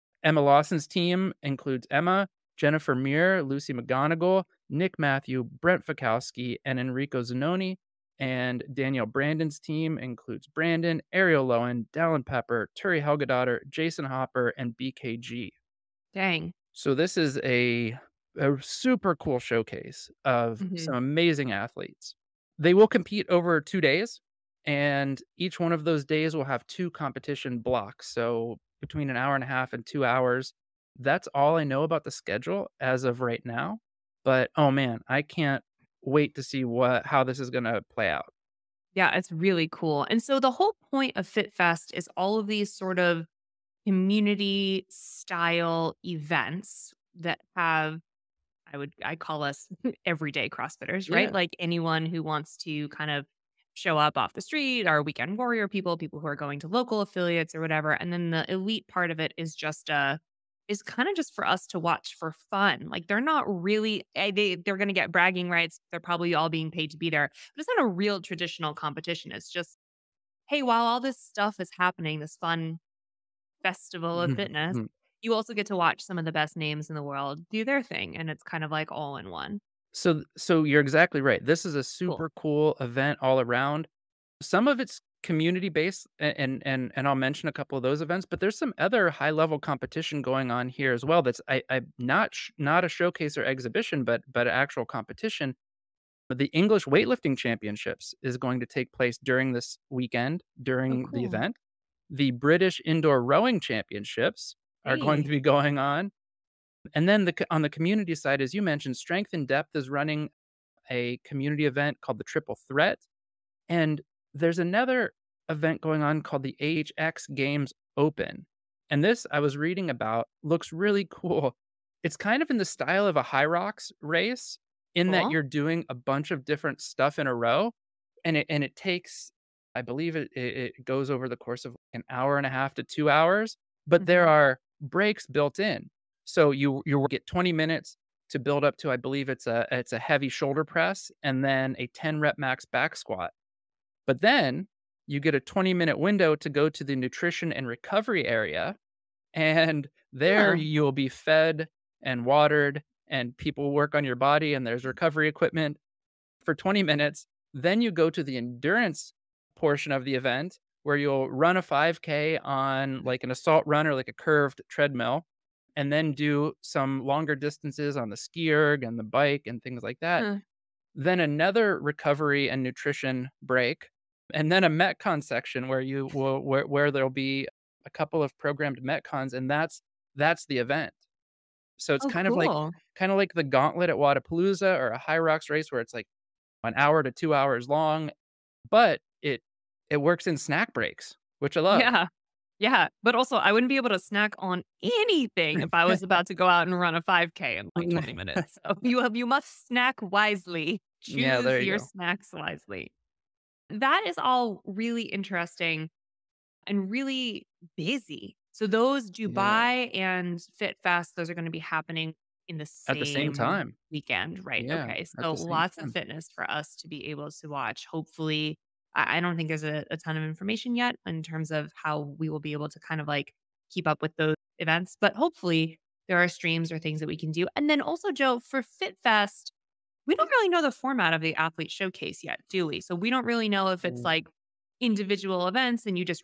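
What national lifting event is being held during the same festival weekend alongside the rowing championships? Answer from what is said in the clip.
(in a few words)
English weightlifting championships.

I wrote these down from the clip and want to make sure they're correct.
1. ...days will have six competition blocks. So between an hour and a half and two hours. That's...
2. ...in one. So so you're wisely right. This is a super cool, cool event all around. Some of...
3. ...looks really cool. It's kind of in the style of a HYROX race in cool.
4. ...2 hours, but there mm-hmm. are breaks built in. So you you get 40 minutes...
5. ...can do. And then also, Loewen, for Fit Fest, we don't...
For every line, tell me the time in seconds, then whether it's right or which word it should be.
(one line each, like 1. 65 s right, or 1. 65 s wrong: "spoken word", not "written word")
1. 26 s wrong: "two", not "six"
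2. 79 s wrong: "exactly", not "wisely"
3. 120 s right
4. 132 s wrong: "20", not "40"
5. 227 s wrong: "Joe", not "Loewen".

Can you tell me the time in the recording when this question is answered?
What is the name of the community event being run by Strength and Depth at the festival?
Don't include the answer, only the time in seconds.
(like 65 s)
112 s.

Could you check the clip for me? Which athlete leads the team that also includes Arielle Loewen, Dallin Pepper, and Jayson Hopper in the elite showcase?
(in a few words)
Danielle Brandon.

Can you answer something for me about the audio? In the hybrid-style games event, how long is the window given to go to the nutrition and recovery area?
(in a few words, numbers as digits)
20 minutes.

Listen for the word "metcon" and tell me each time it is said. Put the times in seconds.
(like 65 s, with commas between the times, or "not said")
174 s, 178 s.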